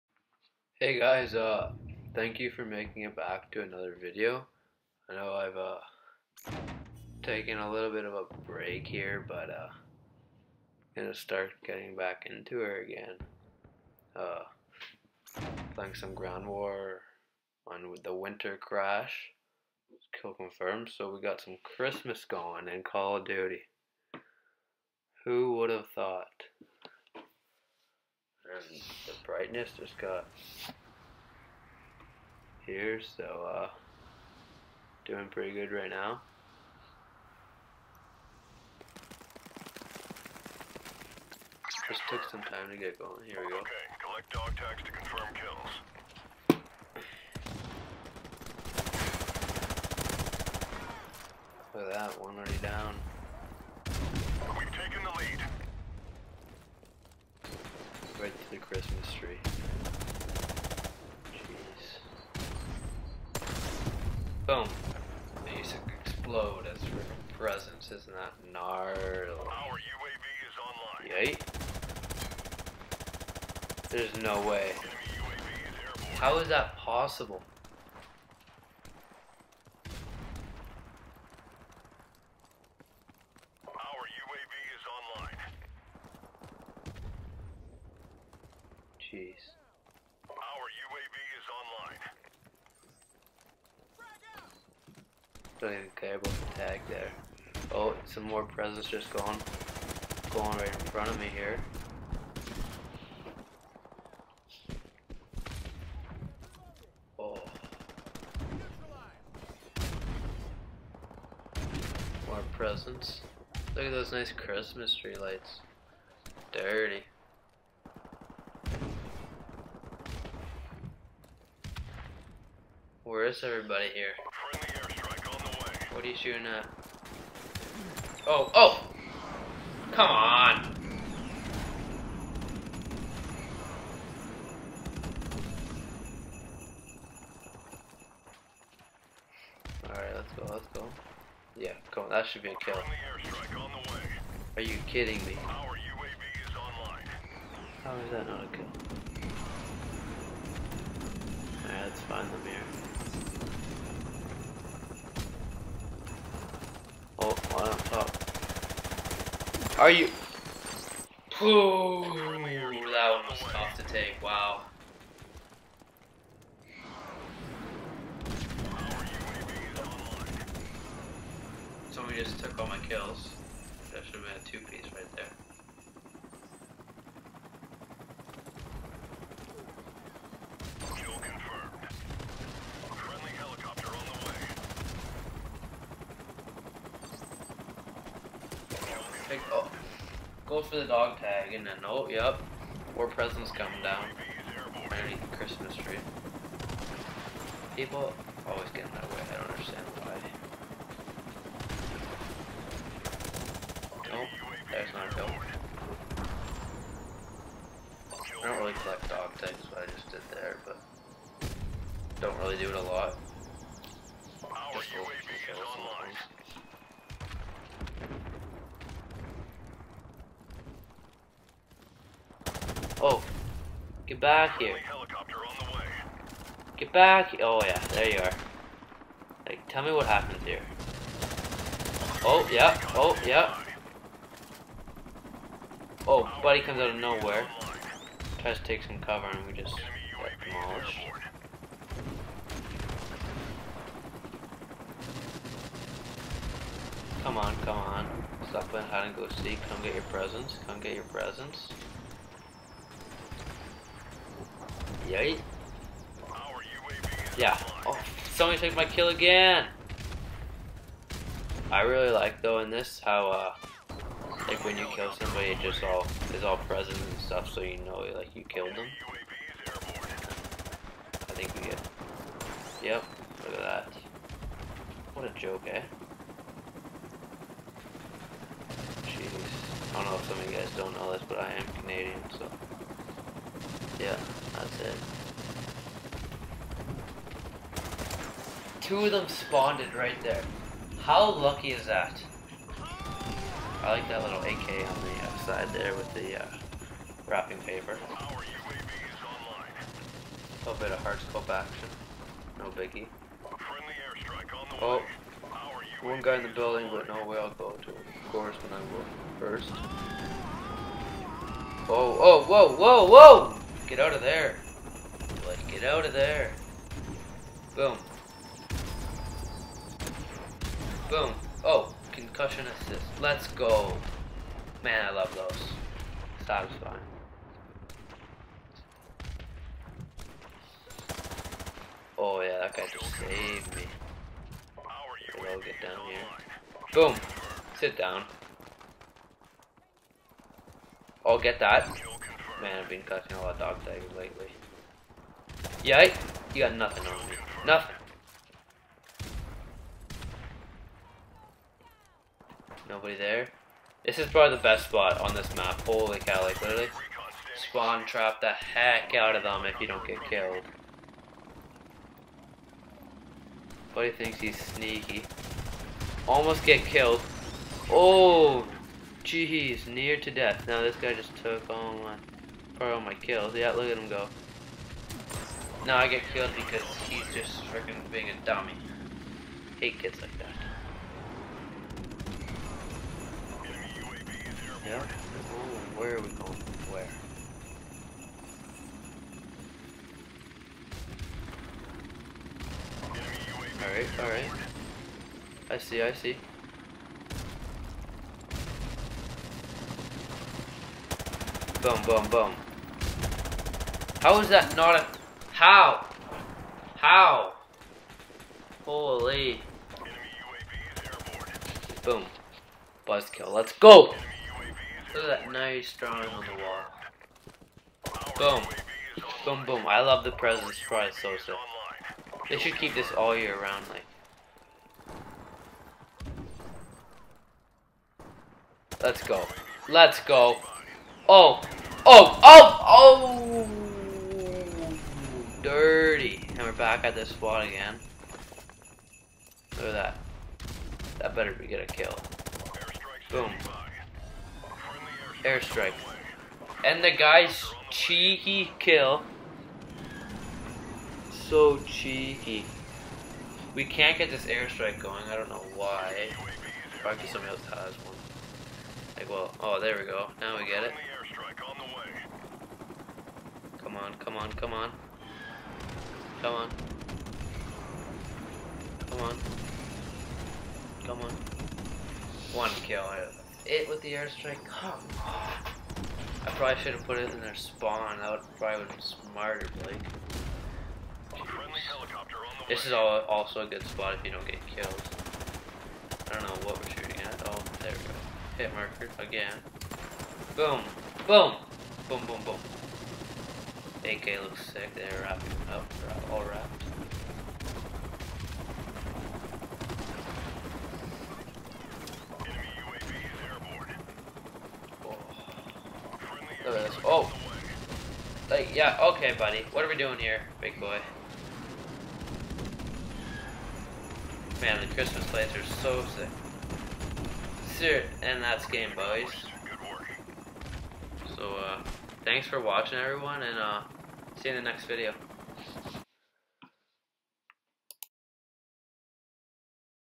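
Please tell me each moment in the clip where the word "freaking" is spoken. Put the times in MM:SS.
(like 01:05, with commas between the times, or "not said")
01:06, 06:17.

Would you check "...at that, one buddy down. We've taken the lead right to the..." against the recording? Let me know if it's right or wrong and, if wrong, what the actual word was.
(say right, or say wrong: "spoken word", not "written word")
wrong: "already", not "buddy".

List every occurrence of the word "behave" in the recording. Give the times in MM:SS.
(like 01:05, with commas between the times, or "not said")
not said.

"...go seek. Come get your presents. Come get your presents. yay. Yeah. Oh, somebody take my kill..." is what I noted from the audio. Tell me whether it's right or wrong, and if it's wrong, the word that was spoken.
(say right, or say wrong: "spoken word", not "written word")
right.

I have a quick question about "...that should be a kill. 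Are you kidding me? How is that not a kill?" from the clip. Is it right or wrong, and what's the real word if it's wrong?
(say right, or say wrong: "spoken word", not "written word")
right.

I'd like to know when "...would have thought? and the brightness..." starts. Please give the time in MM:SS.
00:25.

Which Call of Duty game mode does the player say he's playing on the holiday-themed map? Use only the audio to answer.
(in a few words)
Kill confirmed.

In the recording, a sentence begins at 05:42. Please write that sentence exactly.
Man, I've been catching a lot of dog tags lately.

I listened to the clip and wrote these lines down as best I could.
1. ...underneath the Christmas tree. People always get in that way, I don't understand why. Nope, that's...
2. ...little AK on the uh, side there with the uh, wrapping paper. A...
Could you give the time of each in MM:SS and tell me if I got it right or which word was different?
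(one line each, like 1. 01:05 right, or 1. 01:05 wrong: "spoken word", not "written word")
1. 03:14 right
2. 04:54 right.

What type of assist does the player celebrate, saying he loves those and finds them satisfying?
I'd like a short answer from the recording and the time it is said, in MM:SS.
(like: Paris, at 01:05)
Concussion assist, at 05:22.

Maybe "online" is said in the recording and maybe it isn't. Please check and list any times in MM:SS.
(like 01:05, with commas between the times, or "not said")
01:10, 01:35.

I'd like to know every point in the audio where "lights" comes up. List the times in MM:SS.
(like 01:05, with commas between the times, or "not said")
01:55, 08:35.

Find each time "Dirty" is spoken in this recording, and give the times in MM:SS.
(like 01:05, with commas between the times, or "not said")
01:56, 07:15.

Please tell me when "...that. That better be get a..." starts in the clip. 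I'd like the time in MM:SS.
07:19.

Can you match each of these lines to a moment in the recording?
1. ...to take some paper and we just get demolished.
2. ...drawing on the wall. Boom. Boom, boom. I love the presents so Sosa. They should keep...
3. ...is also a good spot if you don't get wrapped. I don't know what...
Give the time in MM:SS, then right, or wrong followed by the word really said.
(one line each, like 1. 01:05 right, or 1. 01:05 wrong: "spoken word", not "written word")
1. 03:58 wrong: "cover", not "paper"
2. 06:55 right
3. 08:02 wrong: "killed", not "wrapped".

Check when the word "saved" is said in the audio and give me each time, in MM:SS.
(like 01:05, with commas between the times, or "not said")
05:33.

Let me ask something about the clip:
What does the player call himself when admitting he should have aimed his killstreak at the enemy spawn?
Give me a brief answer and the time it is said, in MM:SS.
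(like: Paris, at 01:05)
Blake, at 07:59.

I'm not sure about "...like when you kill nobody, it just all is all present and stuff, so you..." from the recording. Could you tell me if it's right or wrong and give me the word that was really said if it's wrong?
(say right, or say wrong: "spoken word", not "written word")
wrong: "somebody", not "nobody".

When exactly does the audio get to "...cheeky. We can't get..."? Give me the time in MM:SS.
07:31.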